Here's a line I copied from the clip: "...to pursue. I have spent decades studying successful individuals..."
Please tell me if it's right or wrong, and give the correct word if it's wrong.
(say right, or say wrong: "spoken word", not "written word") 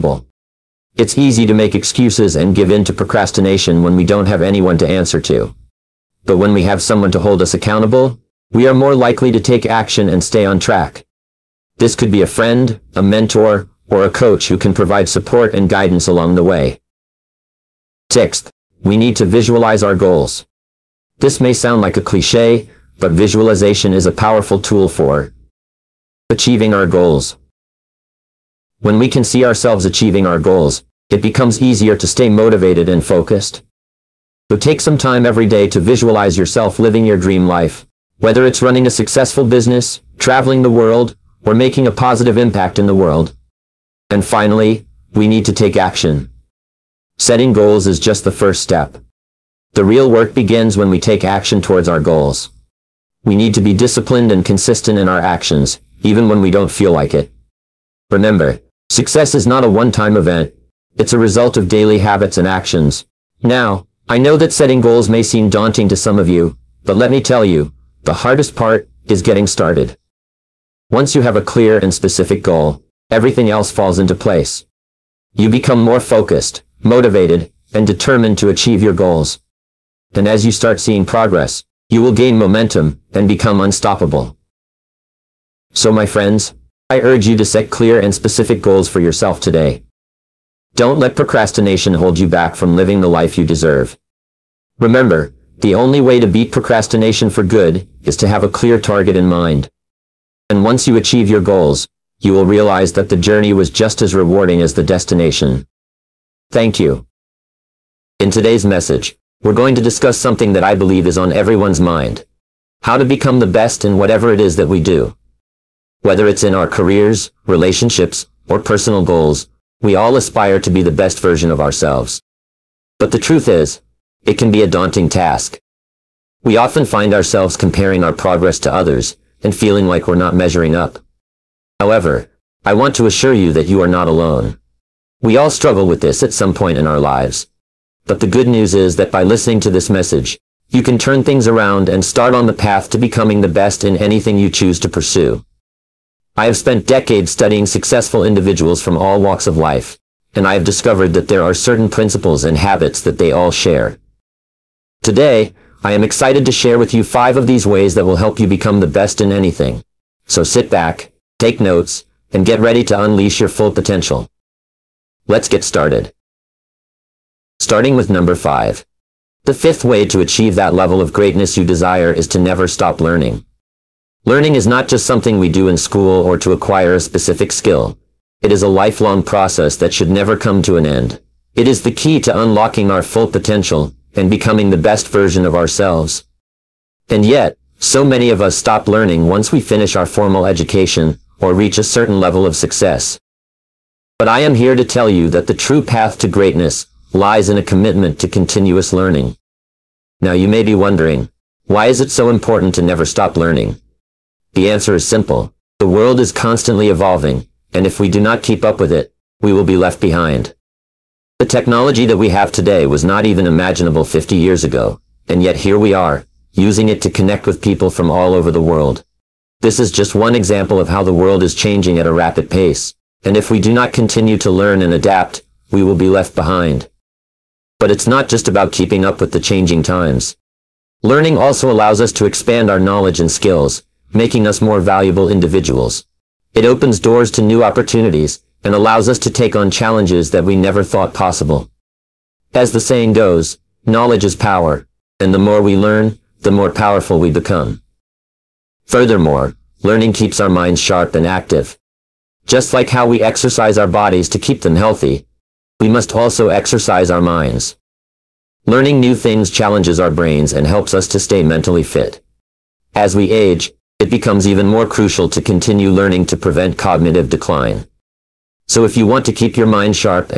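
right.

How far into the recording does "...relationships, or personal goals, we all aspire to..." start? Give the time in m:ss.
1:57.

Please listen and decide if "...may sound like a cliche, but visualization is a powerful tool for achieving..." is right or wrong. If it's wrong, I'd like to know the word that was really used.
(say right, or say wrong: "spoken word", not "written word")
right.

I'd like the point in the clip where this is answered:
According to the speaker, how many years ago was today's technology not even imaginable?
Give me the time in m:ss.
3:34.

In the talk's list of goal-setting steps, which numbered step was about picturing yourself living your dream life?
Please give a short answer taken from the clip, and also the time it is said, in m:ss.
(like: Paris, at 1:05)
Sixth, at 0:18.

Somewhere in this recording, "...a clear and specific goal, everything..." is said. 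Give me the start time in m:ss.
1:11.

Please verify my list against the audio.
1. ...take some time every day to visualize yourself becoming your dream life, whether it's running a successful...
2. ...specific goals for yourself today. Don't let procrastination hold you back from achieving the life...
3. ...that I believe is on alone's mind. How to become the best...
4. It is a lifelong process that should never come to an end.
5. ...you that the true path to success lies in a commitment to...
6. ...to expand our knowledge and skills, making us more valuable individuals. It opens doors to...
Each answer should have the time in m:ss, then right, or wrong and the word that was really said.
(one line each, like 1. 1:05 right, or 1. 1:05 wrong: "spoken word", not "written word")
1. 0:34 wrong: "living", not "becoming"
2. 1:28 wrong: "living", not "achieving"
3. 1:50 wrong: "everyone", not "alone"
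4. 2:58 right
5. 3:15 wrong: "greatness", not "success"
6. 3:52 right.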